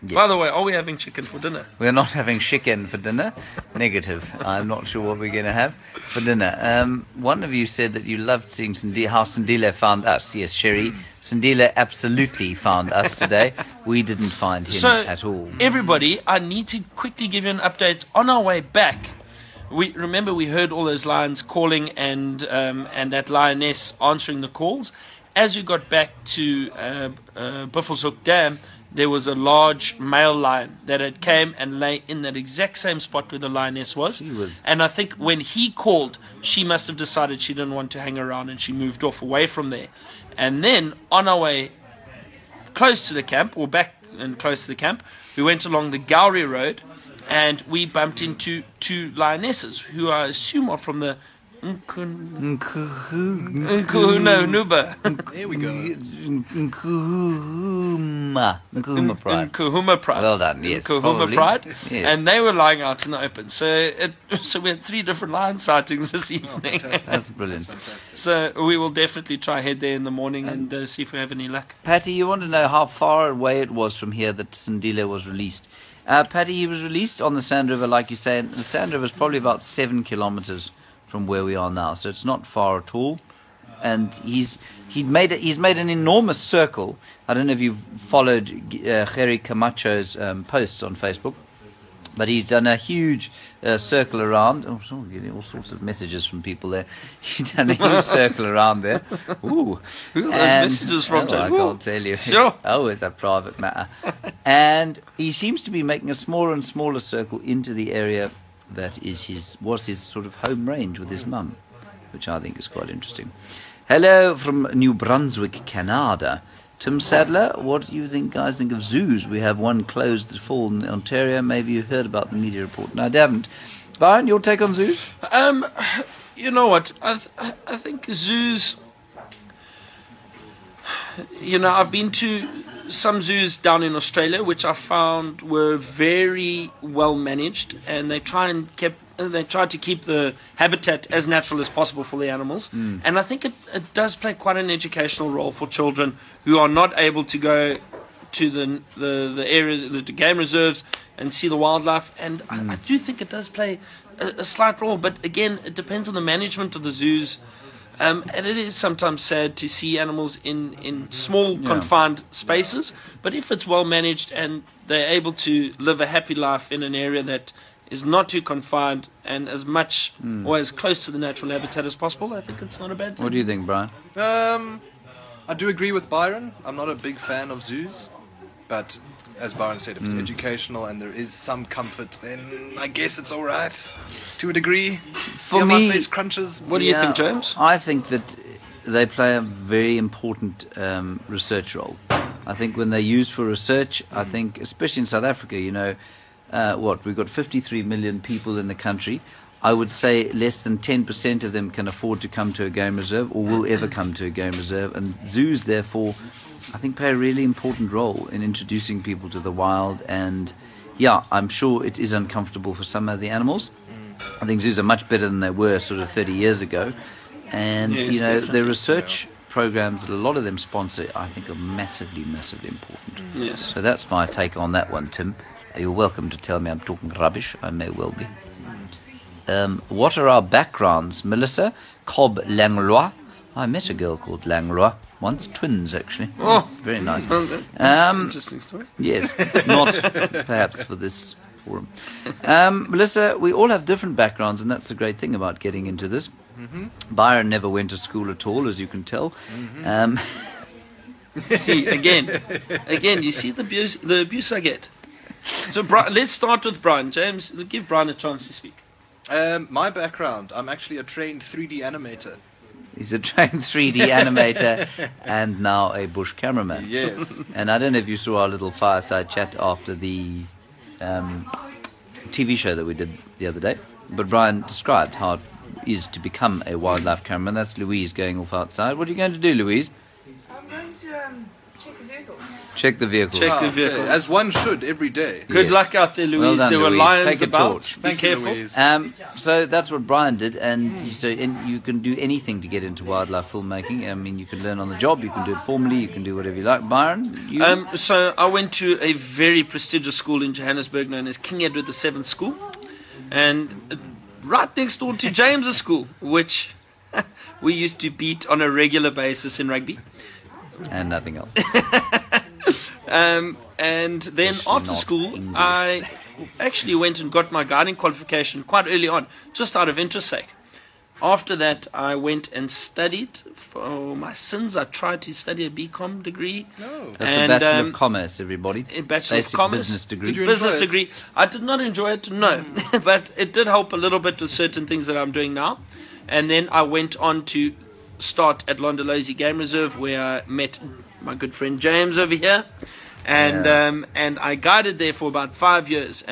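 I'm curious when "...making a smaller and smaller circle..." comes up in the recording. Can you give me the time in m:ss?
1:45.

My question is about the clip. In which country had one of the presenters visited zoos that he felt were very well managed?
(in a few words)
Australia.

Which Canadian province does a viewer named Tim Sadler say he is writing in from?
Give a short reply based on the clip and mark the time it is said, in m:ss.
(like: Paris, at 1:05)
New Brunswick, at 1:54.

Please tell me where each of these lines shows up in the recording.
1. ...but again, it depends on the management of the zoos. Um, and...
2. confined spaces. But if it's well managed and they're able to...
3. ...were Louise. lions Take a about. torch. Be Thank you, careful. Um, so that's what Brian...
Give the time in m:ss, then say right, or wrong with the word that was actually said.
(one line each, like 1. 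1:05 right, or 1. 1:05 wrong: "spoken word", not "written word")
1. 2:34 right
2. 2:41 right
3. 4:46 right.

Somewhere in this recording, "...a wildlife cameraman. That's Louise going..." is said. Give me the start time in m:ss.
4:36.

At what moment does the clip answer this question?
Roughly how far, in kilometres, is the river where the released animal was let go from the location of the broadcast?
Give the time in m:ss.
1:19.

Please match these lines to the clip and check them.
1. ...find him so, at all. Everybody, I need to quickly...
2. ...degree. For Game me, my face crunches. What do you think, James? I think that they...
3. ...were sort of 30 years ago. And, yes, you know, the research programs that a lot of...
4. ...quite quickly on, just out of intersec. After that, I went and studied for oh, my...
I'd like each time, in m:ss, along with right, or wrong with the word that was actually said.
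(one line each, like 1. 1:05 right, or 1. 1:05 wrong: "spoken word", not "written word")
1. 0:14 right
2. 3:04 wrong: "See", not "Game"
3. 3:35 right
4. 5:18 wrong: "early", not "quickly".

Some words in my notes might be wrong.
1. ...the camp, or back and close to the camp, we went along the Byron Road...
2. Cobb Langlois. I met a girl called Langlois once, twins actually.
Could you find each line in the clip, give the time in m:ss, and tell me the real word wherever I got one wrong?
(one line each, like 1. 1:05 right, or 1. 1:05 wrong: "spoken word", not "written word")
1. 0:43 wrong: "Gowrie", not "Byron"
2. 3:52 right.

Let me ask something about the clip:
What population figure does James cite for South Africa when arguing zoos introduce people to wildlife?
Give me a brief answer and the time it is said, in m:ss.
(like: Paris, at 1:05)
53 million, at 3:17.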